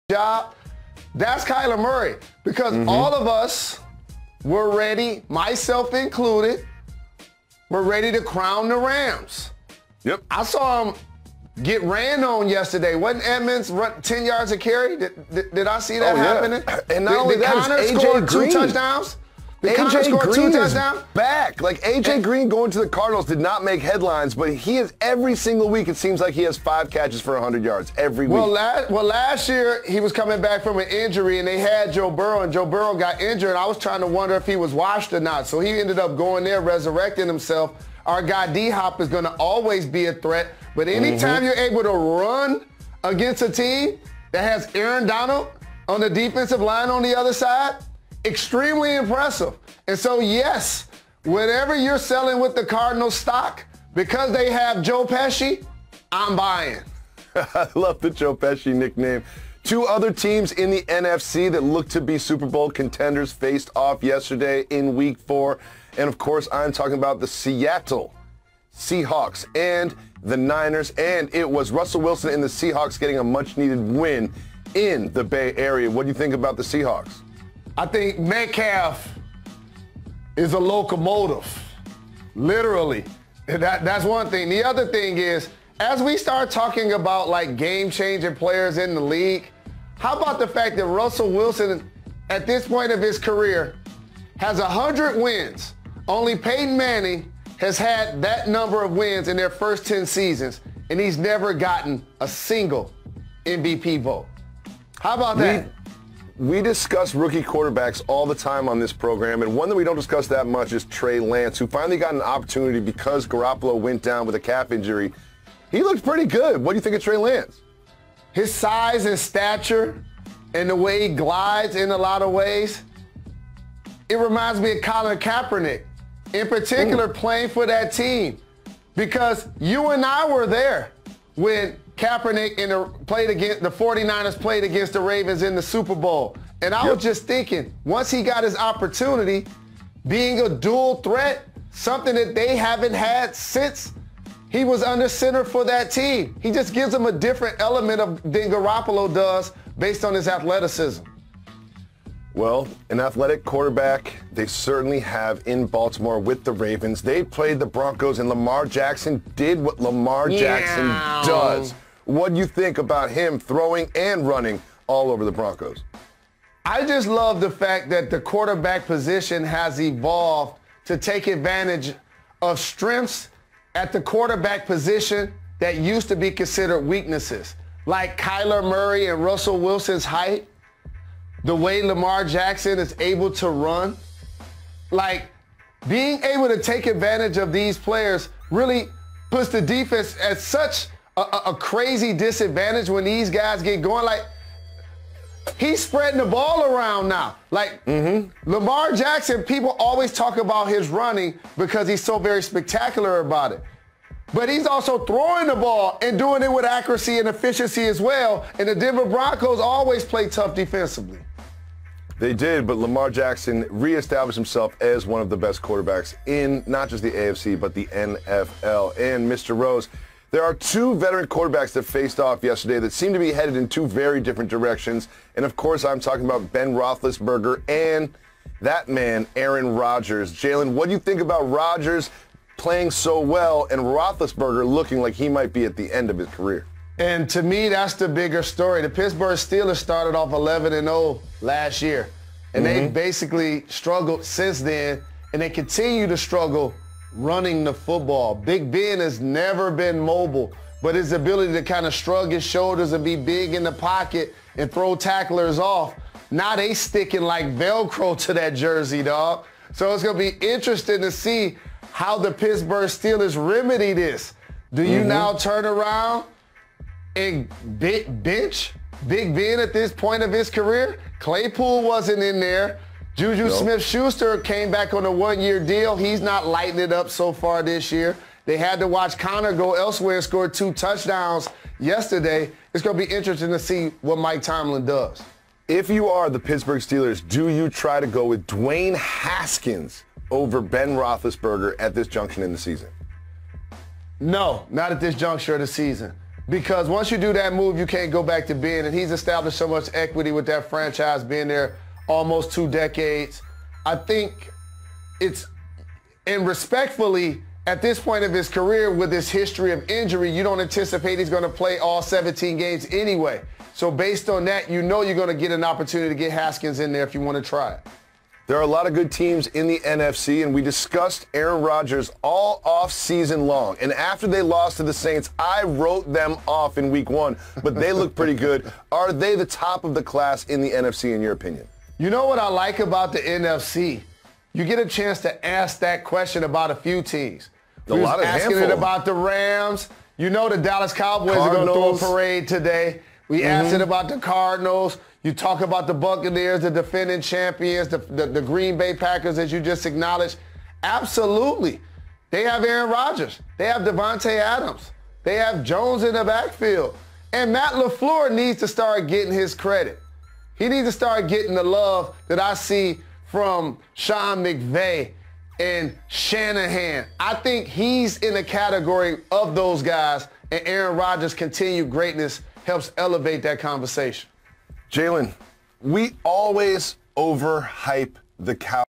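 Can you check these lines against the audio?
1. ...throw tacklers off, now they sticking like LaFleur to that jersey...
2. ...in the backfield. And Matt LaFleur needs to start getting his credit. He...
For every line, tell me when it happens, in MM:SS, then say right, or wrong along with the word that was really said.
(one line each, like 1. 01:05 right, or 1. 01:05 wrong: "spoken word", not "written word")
1. 04:14 wrong: "Velcro", not "LaFleur"
2. 05:56 right.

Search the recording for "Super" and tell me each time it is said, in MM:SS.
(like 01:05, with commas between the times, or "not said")
01:02, 02:15.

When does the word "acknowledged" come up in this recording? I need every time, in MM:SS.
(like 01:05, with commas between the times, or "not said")
05:49.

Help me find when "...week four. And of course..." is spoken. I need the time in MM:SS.
01:04.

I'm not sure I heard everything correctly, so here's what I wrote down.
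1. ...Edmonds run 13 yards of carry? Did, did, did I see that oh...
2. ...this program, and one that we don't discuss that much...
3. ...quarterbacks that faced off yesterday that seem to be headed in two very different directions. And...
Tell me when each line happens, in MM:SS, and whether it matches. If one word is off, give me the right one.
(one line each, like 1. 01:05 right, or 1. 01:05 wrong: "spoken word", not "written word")
1. 00:13 wrong: "10", not "13"
2. 01:48 right
3. 03:41 right.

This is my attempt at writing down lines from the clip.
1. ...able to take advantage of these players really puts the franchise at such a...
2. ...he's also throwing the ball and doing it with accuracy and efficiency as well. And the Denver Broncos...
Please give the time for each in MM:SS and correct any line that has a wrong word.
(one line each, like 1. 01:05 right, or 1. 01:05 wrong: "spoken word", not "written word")
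1. 03:06 wrong: "defense", not "franchise"
2. 03:24 right.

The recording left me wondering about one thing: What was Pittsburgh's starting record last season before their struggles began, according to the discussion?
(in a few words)
11 and 0.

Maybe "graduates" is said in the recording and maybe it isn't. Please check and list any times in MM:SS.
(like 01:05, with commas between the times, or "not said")
not said.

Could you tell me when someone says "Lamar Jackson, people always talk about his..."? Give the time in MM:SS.
03:18.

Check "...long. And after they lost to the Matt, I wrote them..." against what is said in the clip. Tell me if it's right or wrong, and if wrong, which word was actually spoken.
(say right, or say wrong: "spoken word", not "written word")
wrong: "Saints", not "Matt".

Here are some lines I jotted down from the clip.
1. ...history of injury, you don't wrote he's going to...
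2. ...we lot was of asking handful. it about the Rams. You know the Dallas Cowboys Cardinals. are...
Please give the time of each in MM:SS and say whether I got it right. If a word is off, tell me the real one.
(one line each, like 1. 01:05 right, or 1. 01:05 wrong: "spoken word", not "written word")
1. 05:09 wrong: "anticipate", not "wrote"
2. 05:37 right.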